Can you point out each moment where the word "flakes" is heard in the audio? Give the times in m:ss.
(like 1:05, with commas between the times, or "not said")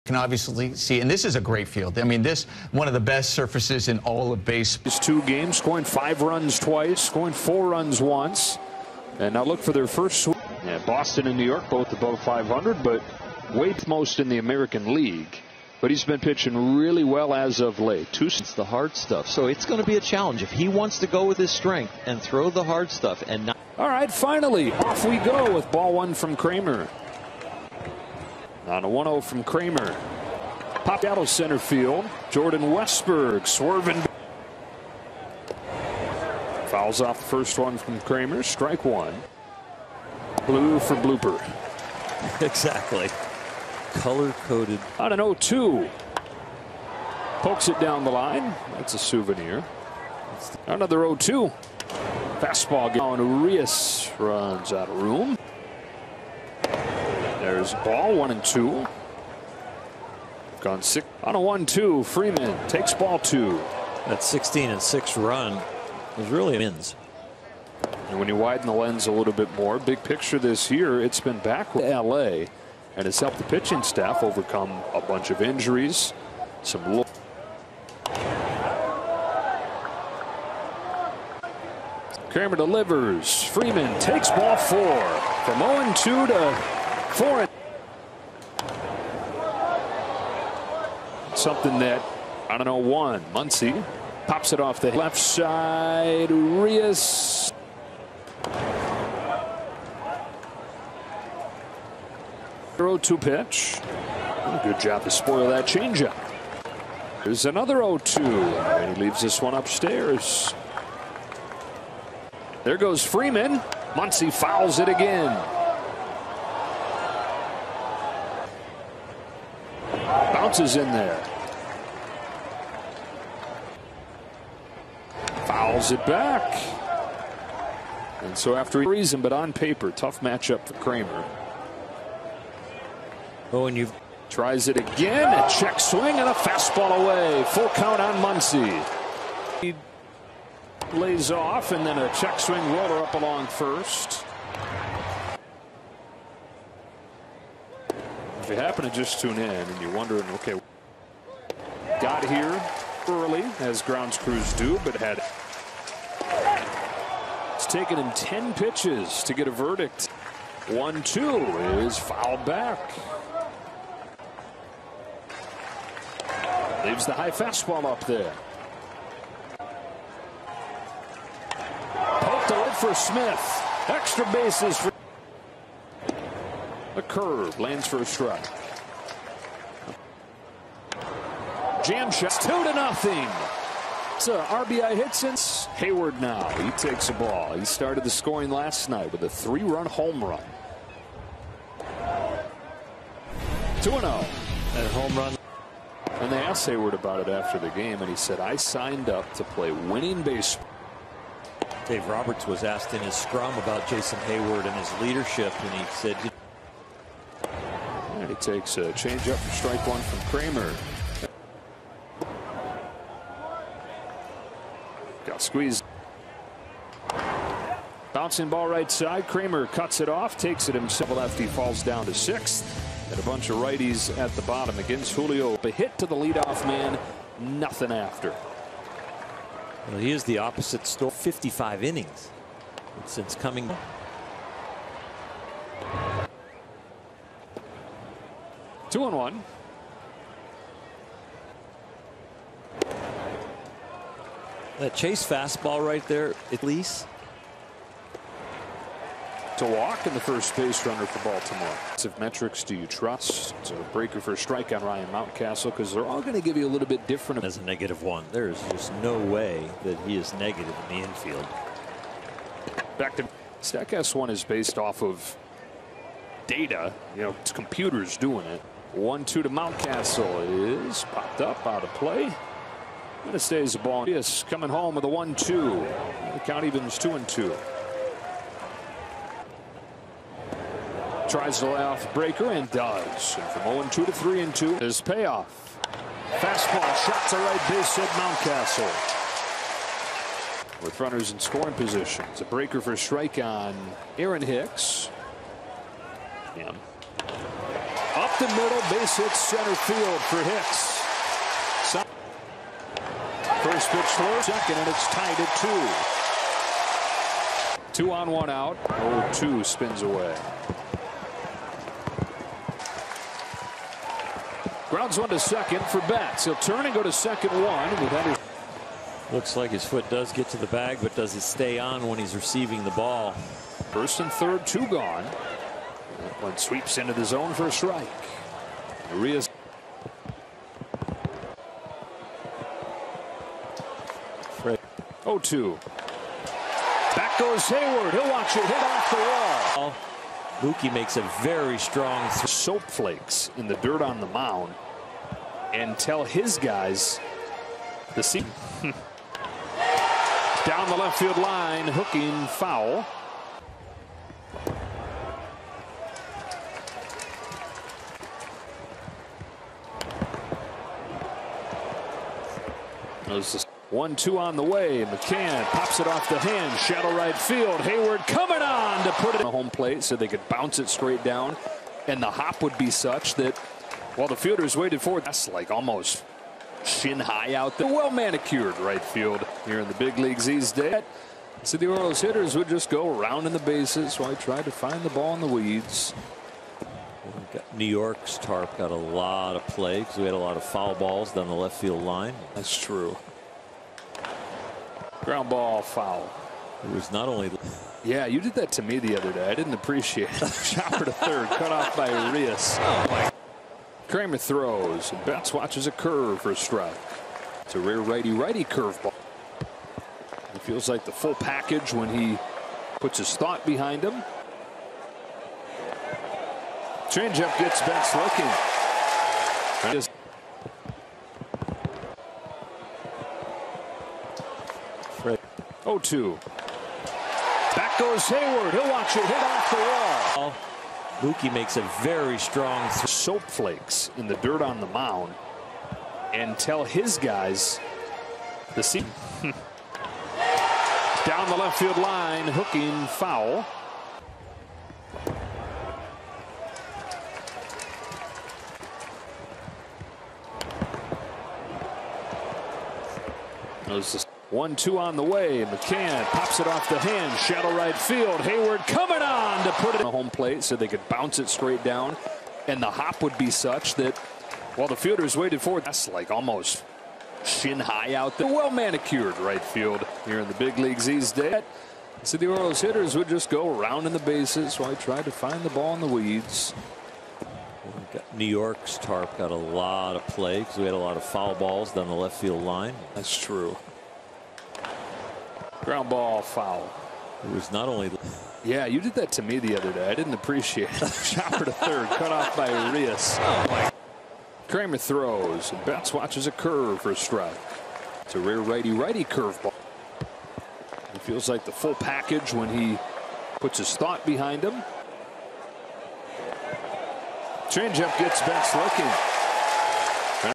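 5:42, 7:13.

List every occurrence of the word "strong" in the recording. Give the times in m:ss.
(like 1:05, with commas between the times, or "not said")
5:41, 7:12.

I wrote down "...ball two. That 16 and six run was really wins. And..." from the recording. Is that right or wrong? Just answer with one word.
right.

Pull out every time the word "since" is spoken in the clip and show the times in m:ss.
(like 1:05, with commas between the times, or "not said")
3:05, 3:53.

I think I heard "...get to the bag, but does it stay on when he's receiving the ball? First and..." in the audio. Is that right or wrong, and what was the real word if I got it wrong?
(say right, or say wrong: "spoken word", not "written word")
right.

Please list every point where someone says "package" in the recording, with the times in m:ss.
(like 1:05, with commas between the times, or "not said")
6:51, 8:21.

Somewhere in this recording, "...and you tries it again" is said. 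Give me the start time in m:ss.
2:13.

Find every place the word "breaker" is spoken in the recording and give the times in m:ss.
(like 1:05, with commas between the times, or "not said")
4:13, 4:42, 4:52.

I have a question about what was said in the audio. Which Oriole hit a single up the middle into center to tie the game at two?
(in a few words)
Aaron Hicks.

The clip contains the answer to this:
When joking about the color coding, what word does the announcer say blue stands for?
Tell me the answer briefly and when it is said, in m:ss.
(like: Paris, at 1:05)
blooper, at 0:40.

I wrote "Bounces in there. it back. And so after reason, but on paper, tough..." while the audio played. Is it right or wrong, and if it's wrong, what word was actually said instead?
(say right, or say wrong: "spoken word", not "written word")
right.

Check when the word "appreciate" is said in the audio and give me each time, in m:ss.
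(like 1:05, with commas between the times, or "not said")
6:39, 8:10.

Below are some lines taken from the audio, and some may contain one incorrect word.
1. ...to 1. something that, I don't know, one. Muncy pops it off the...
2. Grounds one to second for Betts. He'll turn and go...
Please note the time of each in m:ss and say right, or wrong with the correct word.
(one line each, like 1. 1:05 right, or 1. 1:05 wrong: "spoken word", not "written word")
1. 1:26 wrong: "4", not "1"
2. 5:14 right.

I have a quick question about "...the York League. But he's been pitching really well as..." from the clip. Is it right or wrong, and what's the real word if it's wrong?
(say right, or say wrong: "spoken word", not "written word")
wrong: "American", not "York".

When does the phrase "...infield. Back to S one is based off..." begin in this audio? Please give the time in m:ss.
4:21.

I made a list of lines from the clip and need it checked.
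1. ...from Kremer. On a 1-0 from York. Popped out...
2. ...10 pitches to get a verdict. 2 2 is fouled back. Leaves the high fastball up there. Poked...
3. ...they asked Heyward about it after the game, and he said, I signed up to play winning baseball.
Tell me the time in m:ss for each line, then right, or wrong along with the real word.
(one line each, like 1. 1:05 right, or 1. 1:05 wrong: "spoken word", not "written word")
1. 0:26 wrong: "Kremer", not "York"
2. 2:38 wrong: "1", not "2"
3. 3:16 right.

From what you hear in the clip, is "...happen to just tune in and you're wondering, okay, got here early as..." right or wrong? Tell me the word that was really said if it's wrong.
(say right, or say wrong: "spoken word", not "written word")
right.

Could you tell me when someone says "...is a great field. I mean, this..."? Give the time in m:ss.
0:01.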